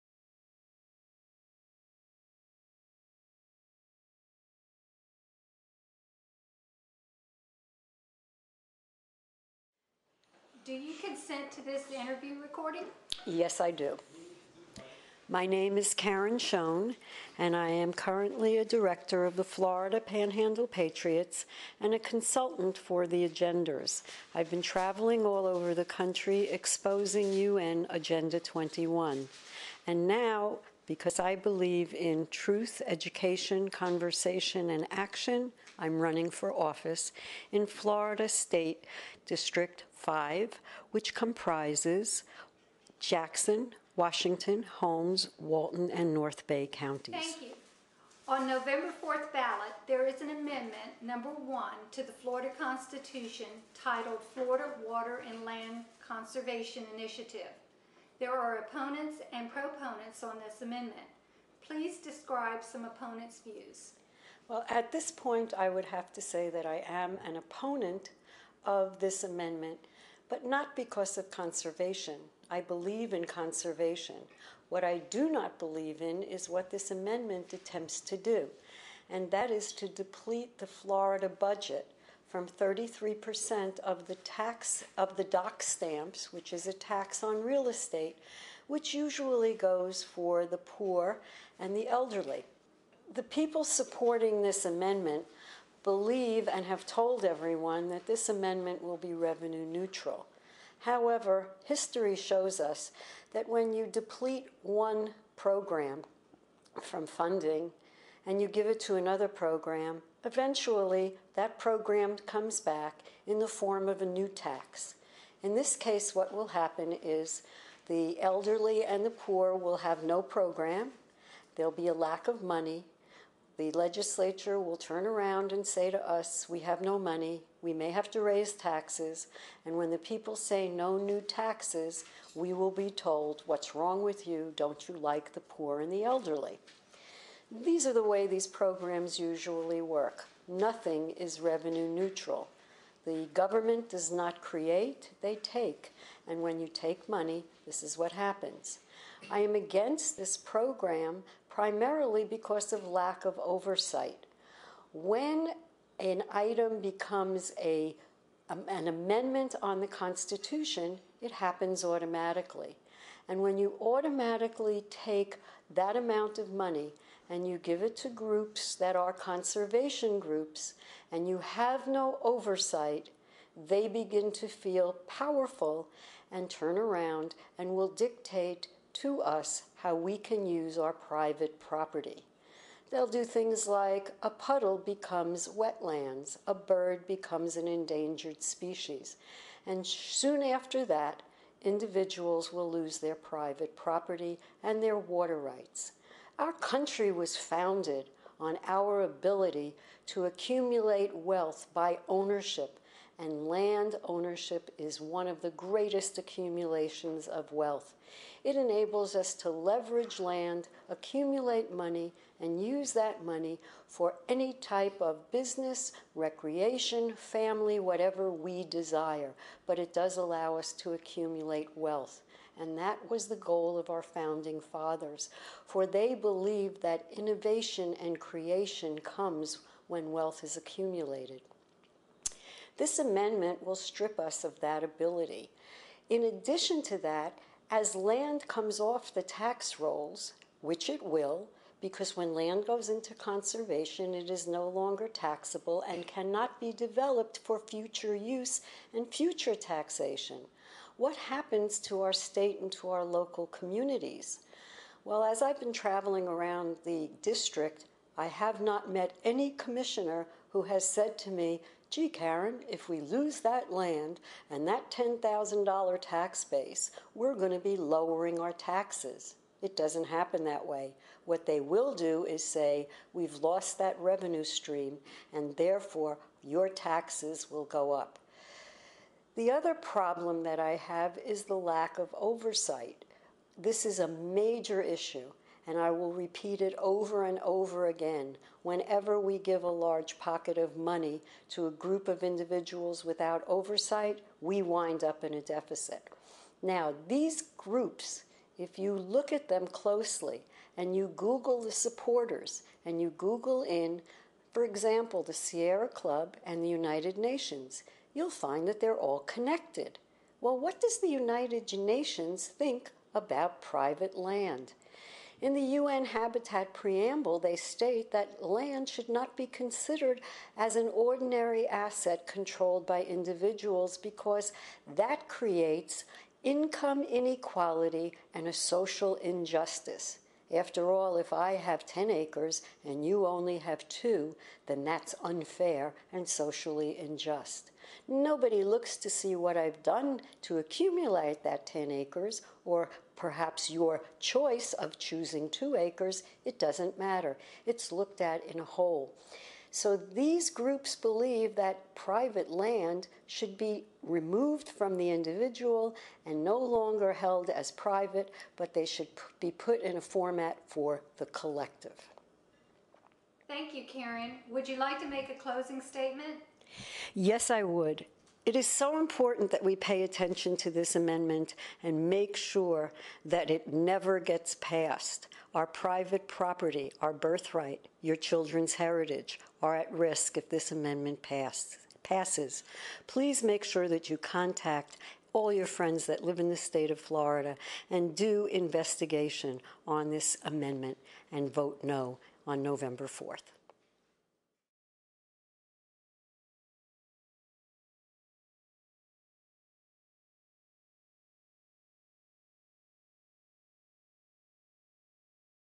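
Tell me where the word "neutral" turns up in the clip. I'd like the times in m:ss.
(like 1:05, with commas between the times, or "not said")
1:39, 2:21.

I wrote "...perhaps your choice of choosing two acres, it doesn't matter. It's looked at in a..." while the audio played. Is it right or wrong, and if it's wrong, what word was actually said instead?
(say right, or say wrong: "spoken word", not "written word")
right.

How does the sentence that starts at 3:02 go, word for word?
They'll do things like a puddle becomes wetlands, a bird becomes an endangered species.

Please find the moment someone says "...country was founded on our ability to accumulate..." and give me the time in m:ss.
3:16.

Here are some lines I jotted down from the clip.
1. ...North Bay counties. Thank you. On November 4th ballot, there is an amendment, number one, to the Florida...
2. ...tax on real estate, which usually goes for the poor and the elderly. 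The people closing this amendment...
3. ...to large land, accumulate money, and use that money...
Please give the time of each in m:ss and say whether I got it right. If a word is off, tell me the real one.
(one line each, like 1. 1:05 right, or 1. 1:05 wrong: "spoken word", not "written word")
1. 0:46 right
2. 1:26 wrong: "supporting", not "closing"
3. 3:29 wrong: "leverage", not "large".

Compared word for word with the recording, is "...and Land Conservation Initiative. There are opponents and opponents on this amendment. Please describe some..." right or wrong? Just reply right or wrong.
wrong.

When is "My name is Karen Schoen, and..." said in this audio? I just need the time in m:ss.
0:15.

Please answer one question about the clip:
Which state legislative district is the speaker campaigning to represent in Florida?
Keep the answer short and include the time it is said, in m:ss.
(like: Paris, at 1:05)
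District 5, at 0:39.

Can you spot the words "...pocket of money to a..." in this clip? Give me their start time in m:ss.
4:50.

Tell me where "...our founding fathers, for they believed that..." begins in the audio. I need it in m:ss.
3:43.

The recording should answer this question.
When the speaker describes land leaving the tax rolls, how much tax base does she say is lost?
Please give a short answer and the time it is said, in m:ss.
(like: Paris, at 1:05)
$10,000, at 4:24.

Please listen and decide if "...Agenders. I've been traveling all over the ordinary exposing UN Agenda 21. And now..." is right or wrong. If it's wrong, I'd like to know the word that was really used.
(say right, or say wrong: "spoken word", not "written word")
wrong: "country", not "ordinary".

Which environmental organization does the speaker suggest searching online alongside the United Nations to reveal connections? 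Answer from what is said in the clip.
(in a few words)
Sierra Club.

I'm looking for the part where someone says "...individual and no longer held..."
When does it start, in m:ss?
5:55.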